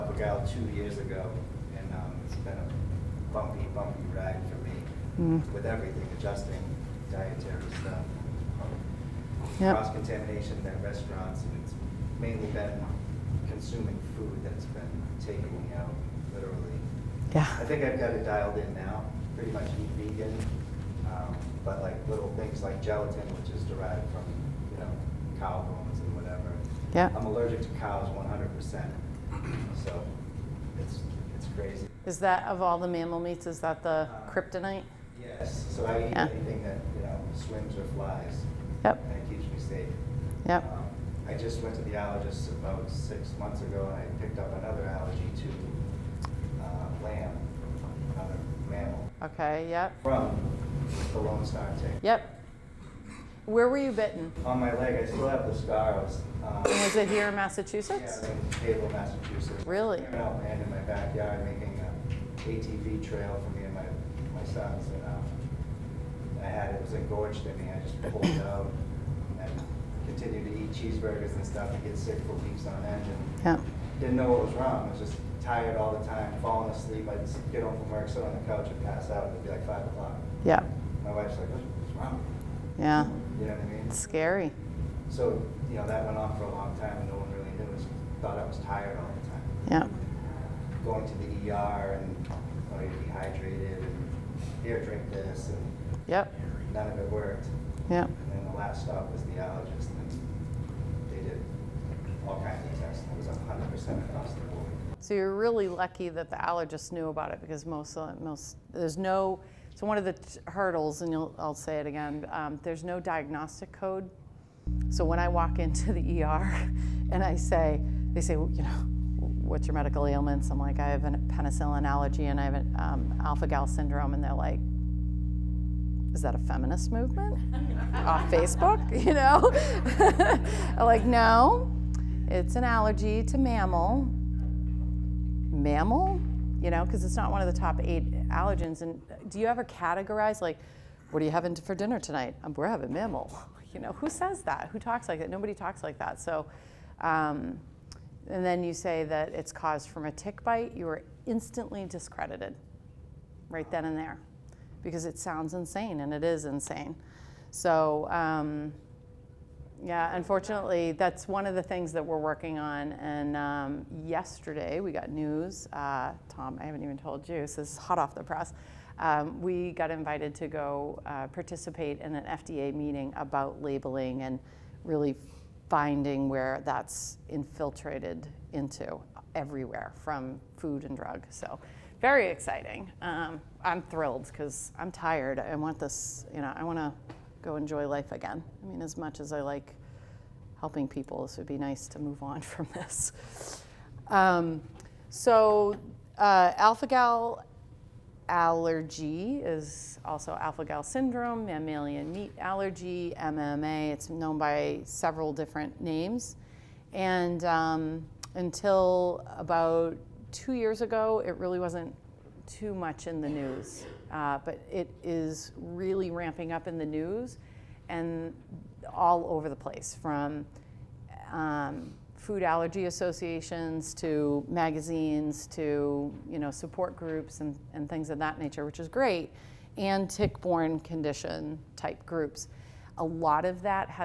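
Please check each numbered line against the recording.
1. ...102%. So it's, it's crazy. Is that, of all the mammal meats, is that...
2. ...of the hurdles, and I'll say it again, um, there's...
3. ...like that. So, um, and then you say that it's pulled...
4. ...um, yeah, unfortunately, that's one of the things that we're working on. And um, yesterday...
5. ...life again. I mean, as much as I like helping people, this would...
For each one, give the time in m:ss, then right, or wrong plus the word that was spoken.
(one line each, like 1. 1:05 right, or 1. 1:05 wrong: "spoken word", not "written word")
1. 0:28 wrong: "100", not "102"
2. 1:49 right
3. 2:25 wrong: "caused", not "pulled"
4. 2:38 right
5. 3:07 right.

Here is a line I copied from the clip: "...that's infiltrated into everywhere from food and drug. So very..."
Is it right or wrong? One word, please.
right.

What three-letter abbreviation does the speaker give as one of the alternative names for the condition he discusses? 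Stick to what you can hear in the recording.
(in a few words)
MMA.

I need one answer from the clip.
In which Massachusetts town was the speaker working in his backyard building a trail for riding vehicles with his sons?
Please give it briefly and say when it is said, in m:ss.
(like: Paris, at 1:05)
Cable, at 0:58.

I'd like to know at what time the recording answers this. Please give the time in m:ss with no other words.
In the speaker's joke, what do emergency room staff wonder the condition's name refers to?
2:06.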